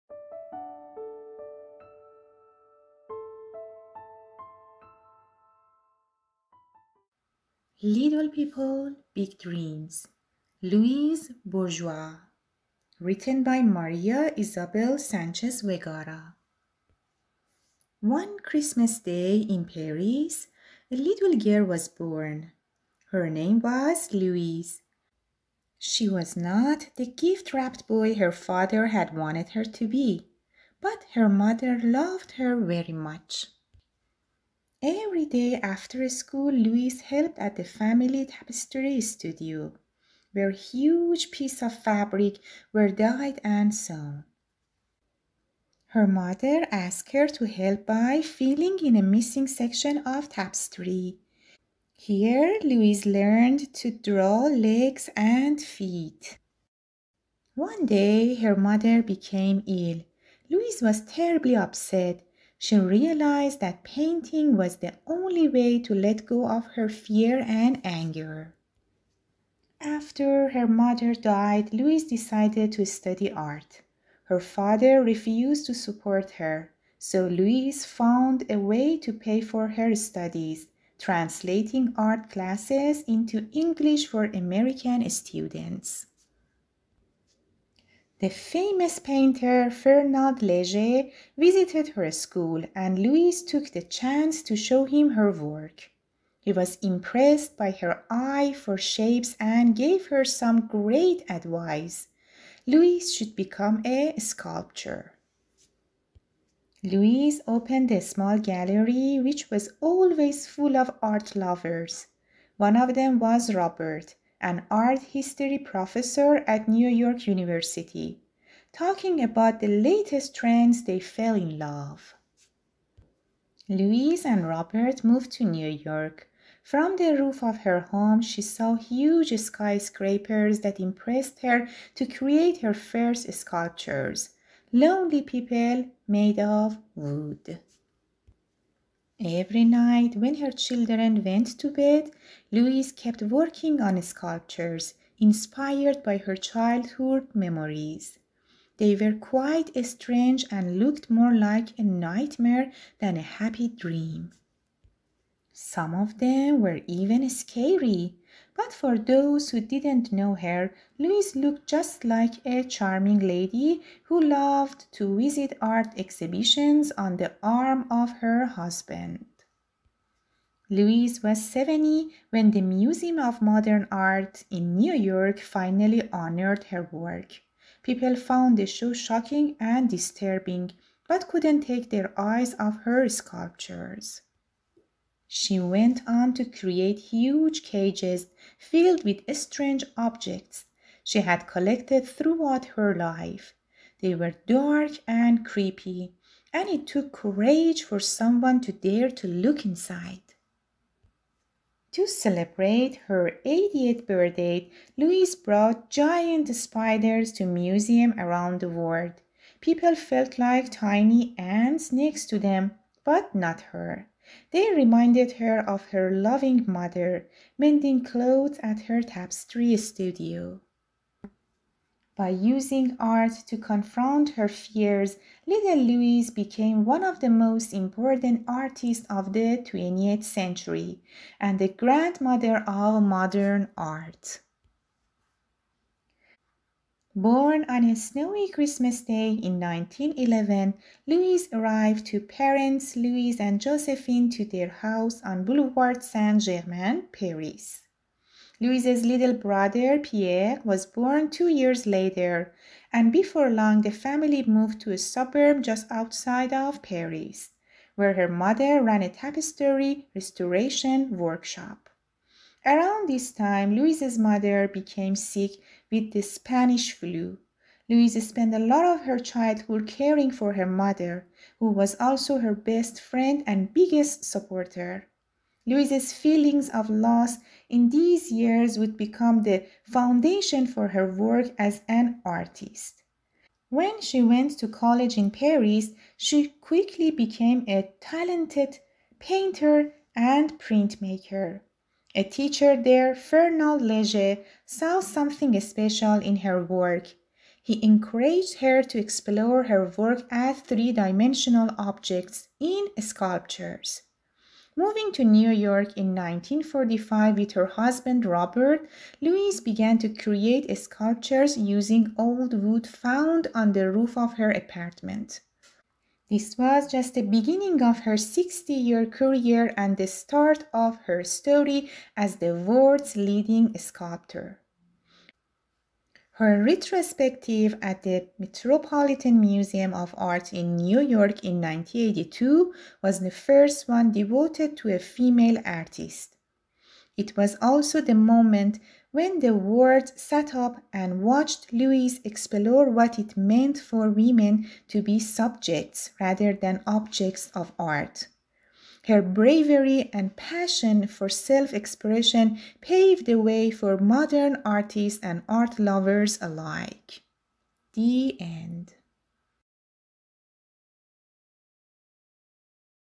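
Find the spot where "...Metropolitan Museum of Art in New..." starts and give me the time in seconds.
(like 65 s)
328 s.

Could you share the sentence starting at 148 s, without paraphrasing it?
They were quite strange and looked more like a nightmare than a happy dream.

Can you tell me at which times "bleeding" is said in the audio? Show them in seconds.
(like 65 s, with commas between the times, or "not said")
not said.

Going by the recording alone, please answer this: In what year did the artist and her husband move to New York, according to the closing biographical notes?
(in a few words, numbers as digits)
1945.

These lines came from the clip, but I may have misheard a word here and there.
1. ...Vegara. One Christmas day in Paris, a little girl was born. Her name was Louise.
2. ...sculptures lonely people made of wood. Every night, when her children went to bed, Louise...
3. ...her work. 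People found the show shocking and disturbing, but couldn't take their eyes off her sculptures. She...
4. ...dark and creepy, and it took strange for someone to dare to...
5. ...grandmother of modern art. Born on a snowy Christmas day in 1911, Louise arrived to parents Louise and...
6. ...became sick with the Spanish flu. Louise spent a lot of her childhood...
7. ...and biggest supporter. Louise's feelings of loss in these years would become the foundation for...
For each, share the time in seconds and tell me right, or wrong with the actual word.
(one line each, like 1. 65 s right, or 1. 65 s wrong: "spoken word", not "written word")
1. 15 s right
2. 133 s right
3. 176 s right
4. 194 s wrong: "courage", not "strange"
5. 231 s right
6. 264 s right
7. 273 s right.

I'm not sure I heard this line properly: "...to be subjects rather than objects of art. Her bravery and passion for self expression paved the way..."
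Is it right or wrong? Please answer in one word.
right.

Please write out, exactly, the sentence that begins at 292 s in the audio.
A teacher there, Fernand Leger, saw something special in her work.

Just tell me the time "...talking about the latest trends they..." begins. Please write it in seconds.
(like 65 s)
118 s.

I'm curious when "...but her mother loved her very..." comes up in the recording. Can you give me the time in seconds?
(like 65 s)
30 s.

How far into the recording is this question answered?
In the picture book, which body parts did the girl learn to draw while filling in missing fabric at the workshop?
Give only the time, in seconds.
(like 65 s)
54 s.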